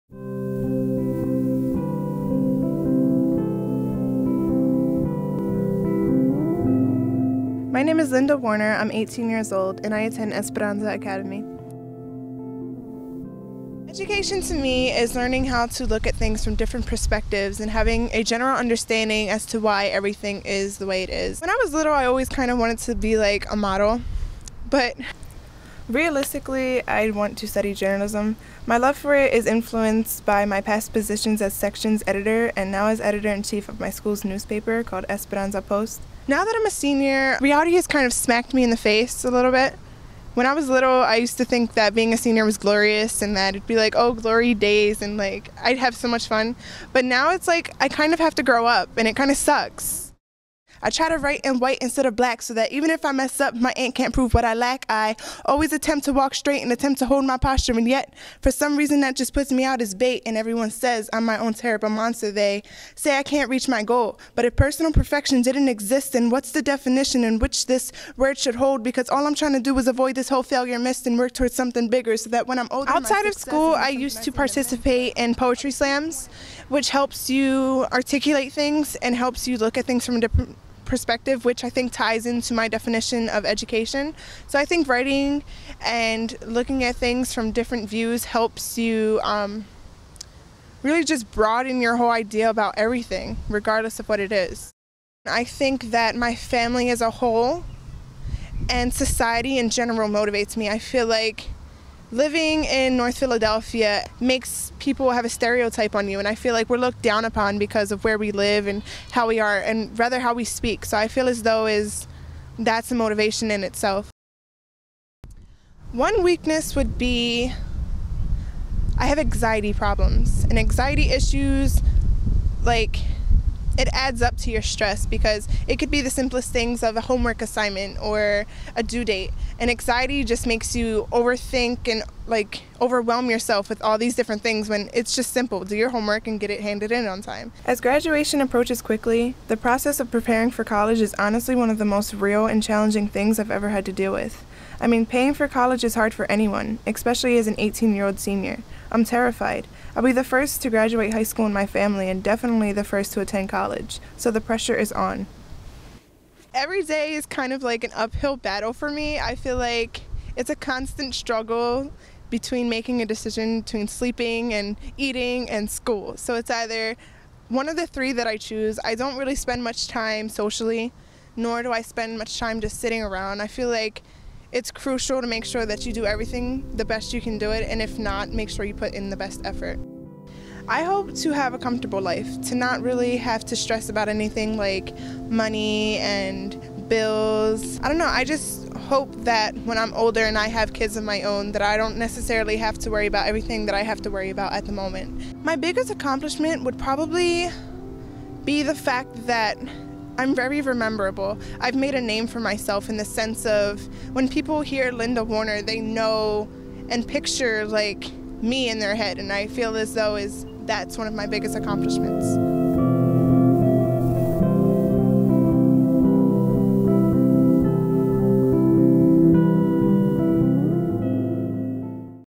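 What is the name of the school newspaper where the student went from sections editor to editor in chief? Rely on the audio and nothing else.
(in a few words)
Esperanza Post.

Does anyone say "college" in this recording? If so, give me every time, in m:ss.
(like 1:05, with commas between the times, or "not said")
2:20, 2:25, 2:33.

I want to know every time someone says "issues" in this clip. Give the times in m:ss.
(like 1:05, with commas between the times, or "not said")
2:01.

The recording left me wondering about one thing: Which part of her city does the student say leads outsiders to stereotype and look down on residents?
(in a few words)
North Philadelphia.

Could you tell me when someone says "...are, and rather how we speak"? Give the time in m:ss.
1:49.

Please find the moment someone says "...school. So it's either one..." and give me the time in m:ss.
2:45.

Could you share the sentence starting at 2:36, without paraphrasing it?
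Every day is kind of like an uphill battle for me.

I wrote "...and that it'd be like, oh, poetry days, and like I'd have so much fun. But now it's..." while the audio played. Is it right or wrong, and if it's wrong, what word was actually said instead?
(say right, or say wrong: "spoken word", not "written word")
wrong: "glory", not "poetry".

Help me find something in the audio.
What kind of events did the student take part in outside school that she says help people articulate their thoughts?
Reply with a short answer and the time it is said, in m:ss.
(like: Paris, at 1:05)
Poetry slams, at 1:15.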